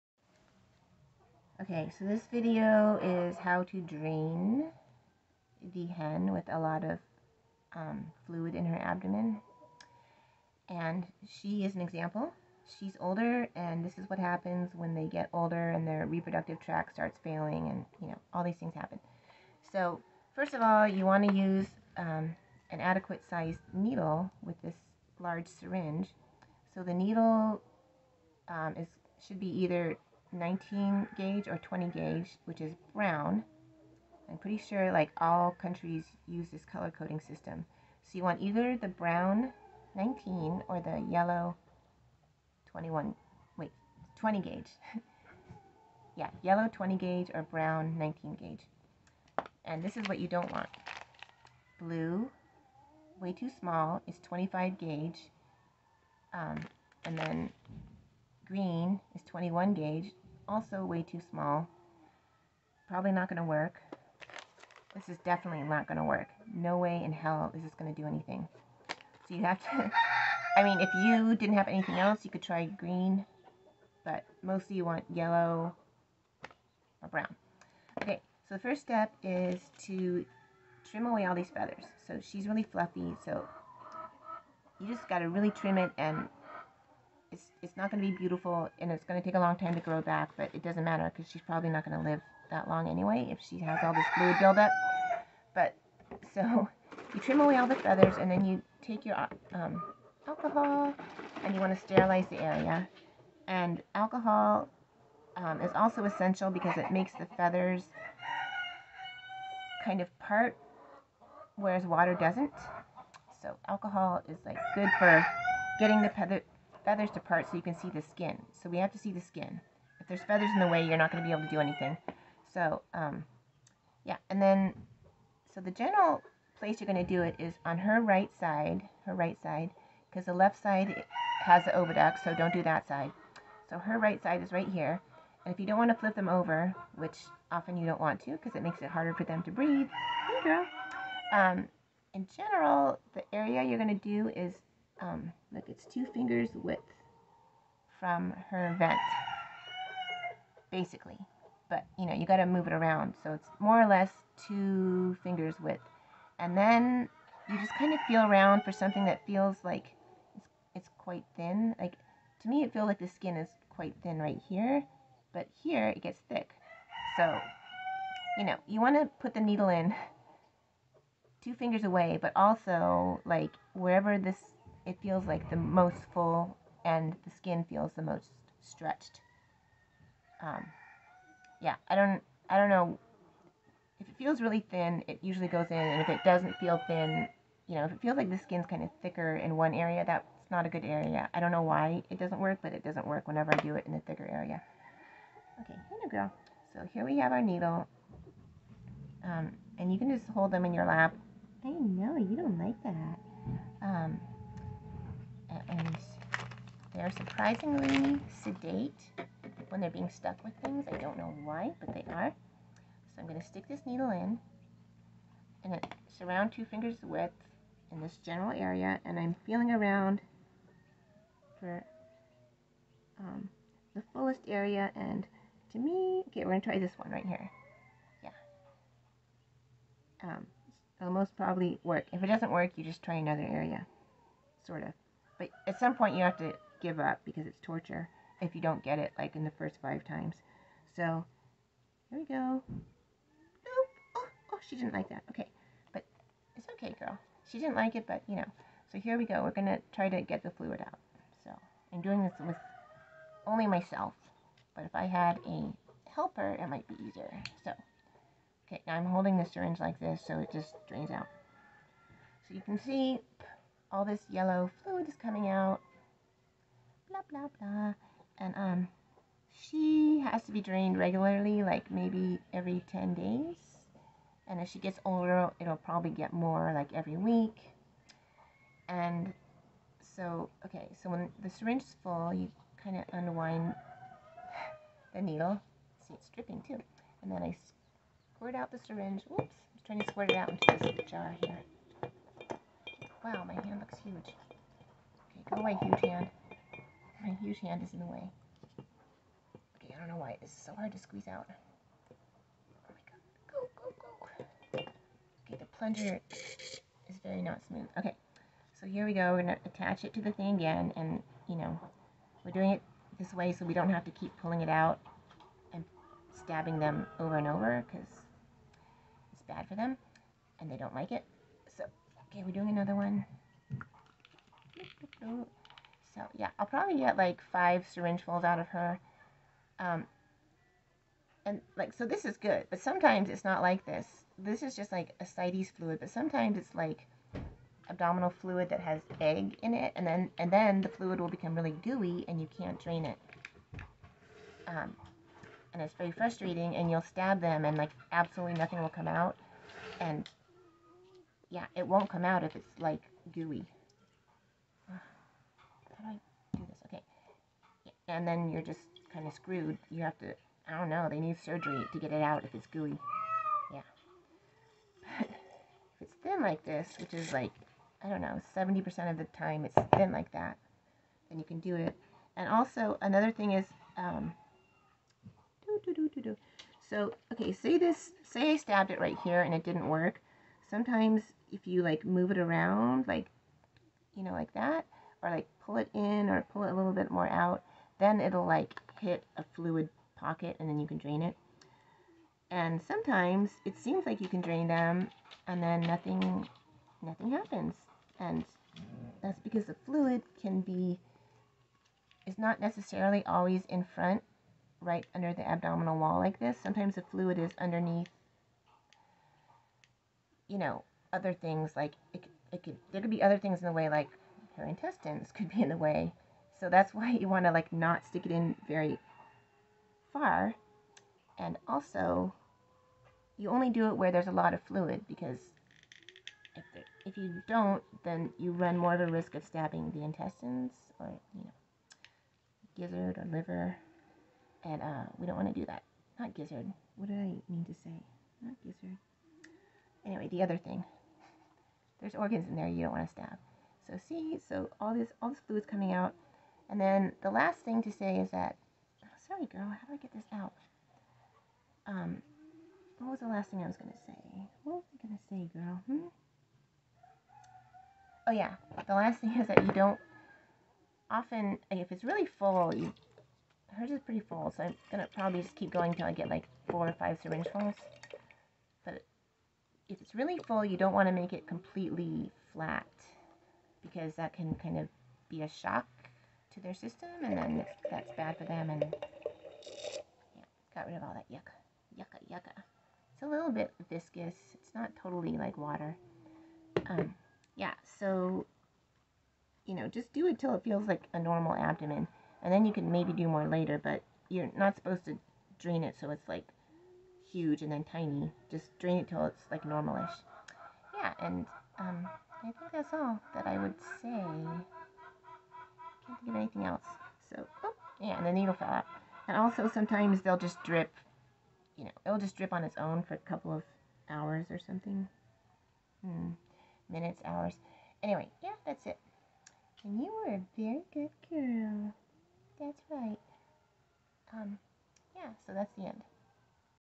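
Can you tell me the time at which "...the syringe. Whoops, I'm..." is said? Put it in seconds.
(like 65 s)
288 s.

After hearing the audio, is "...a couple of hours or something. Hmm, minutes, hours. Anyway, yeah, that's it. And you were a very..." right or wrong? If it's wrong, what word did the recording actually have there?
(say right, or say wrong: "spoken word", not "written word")
right.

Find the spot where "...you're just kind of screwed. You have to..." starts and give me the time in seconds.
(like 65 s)
358 s.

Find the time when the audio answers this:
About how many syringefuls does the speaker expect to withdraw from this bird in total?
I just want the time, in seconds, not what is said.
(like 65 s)
327 s.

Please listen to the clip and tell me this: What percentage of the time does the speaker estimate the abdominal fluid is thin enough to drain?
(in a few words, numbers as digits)
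70%.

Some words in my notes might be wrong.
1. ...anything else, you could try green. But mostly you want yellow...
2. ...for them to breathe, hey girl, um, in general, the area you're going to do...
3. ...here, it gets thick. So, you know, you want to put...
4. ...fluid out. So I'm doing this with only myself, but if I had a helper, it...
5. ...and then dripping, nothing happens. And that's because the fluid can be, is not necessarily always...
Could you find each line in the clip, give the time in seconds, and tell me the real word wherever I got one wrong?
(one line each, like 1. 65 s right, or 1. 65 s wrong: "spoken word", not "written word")
1. 71 s right
2. 139 s right
3. 165 s right
4. 250 s right
5. 395 s wrong: "nothing", not "dripping".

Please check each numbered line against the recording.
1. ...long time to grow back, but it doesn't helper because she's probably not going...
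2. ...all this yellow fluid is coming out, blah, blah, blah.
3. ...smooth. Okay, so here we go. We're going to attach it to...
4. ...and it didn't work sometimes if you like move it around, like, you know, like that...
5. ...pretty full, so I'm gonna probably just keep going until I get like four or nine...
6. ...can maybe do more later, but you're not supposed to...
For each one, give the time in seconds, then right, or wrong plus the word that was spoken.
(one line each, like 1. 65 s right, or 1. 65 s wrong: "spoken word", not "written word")
1. 89 s wrong: "matter", not "helper"
2. 263 s right
3. 307 s right
4. 379 s right
5. 464 s wrong: "five", not "nine"
6. 492 s right.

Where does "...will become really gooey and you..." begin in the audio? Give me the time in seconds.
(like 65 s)
341 s.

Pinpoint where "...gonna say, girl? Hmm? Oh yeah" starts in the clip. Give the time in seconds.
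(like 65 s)
455 s.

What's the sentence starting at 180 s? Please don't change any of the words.
Um, yeah, I don't, I don't know.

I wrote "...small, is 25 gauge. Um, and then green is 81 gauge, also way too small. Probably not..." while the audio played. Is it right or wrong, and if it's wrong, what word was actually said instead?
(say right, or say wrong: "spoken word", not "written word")
wrong: "21", not "81".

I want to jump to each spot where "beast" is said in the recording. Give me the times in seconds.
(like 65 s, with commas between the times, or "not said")
not said.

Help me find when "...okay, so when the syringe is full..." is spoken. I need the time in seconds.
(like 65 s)
280 s.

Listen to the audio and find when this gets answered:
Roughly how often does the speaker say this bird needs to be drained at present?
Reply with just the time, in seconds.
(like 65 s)
272 s.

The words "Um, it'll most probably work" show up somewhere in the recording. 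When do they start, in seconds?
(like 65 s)
230 s.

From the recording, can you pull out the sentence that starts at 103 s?
And alcohol um, is also essential because it makes the feathers kind of part, whereas water doesn't.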